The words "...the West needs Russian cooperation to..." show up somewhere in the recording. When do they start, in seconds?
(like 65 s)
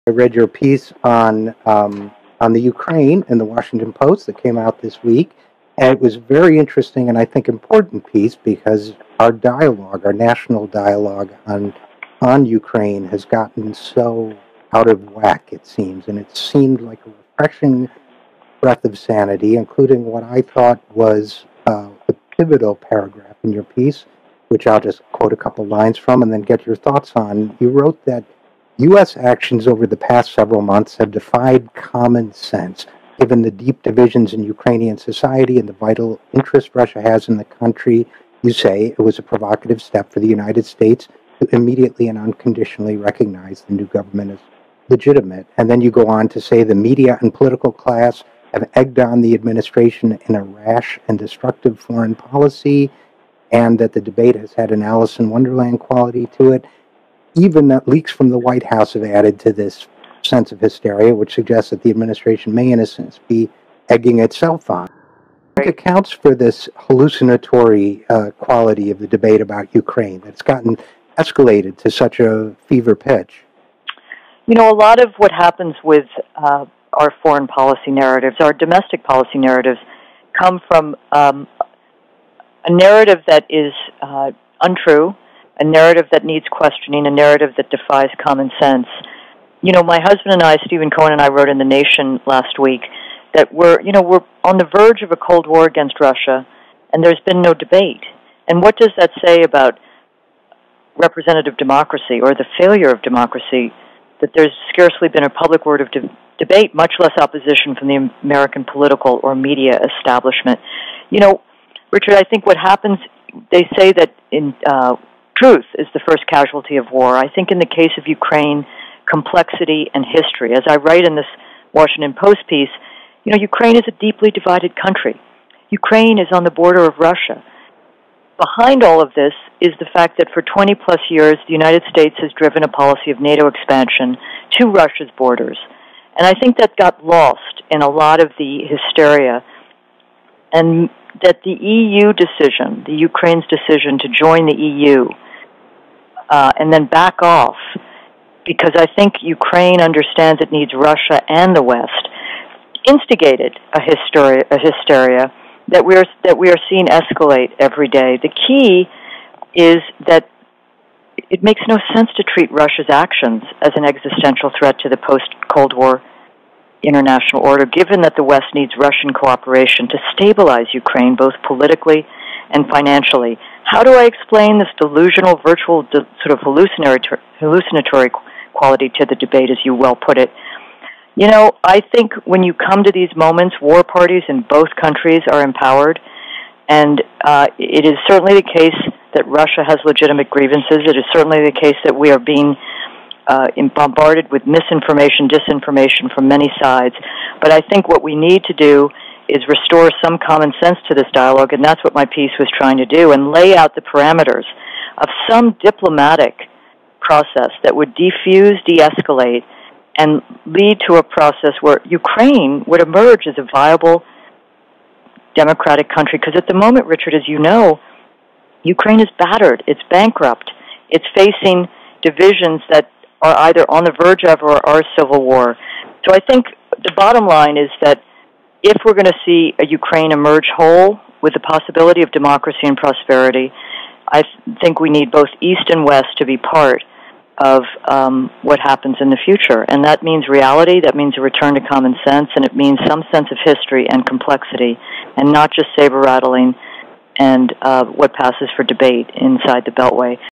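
168 s.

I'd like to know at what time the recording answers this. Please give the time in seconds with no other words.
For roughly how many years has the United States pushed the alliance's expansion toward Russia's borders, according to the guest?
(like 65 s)
130 s.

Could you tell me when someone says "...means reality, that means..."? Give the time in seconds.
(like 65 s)
240 s.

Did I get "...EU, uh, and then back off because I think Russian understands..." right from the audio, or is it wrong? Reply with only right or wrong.
wrong.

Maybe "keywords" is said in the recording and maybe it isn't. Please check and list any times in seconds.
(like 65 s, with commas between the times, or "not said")
not said.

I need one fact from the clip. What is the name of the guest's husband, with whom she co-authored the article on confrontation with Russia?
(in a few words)
Stephen Cohen.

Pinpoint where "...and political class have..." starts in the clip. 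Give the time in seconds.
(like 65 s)
47 s.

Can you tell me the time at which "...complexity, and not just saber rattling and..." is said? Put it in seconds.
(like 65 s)
244 s.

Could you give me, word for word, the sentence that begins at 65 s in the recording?
It accounts for this hallucinatory uh, quality of the debate about Ukraine that's gotten escalated to such a fever pitch.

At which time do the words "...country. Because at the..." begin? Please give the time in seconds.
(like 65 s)
215 s.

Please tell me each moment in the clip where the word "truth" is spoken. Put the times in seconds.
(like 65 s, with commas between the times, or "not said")
115 s.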